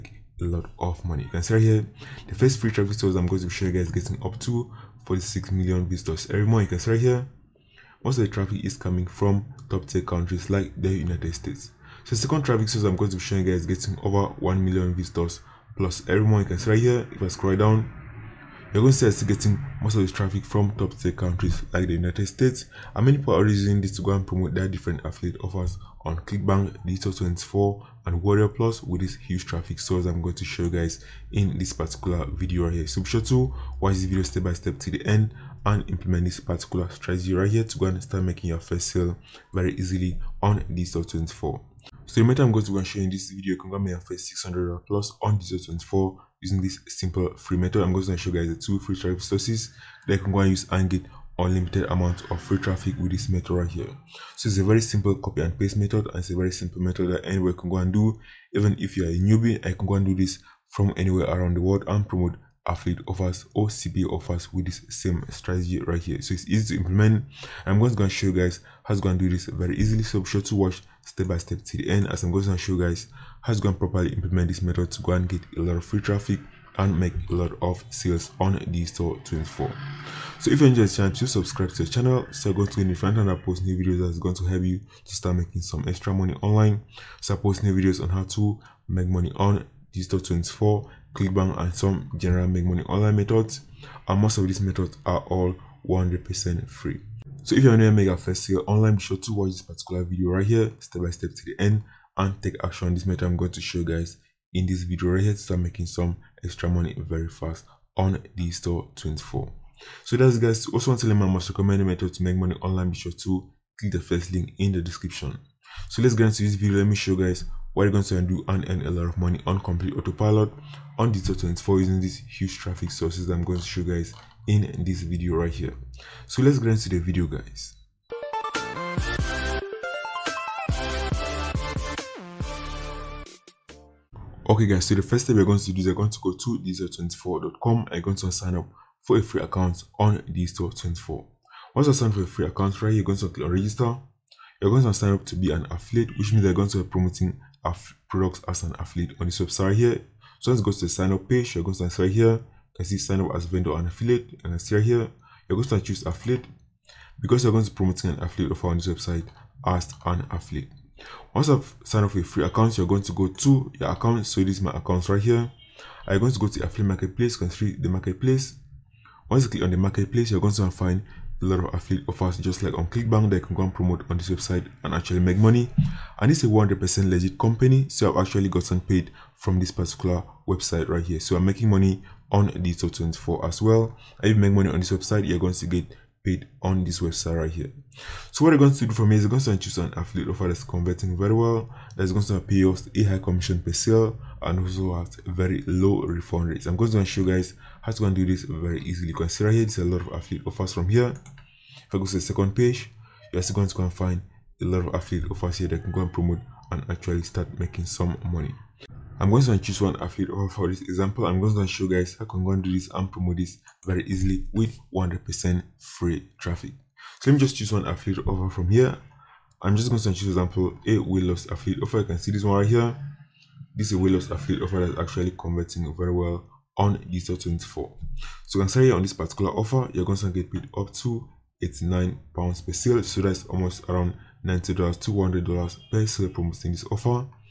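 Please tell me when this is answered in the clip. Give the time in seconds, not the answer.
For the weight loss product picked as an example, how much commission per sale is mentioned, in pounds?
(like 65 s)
231 s.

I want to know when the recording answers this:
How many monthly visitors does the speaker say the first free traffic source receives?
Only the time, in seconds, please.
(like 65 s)
5 s.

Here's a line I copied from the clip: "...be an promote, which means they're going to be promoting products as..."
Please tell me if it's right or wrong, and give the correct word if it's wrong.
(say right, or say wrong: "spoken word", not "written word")
wrong: "affiliate", not "promote".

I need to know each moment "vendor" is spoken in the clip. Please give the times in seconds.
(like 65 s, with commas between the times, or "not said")
153 s.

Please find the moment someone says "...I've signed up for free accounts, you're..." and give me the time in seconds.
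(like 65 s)
161 s.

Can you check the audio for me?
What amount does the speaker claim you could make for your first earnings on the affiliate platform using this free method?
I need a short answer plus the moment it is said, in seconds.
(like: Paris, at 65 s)
600 plus, at 44 s.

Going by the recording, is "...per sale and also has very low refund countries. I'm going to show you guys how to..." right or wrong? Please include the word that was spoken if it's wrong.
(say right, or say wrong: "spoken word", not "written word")
wrong: "rates", not "countries".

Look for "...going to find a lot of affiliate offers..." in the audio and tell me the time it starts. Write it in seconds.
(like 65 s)
170 s.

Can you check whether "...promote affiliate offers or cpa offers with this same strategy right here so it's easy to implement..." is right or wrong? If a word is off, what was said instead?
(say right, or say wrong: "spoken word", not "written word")
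right.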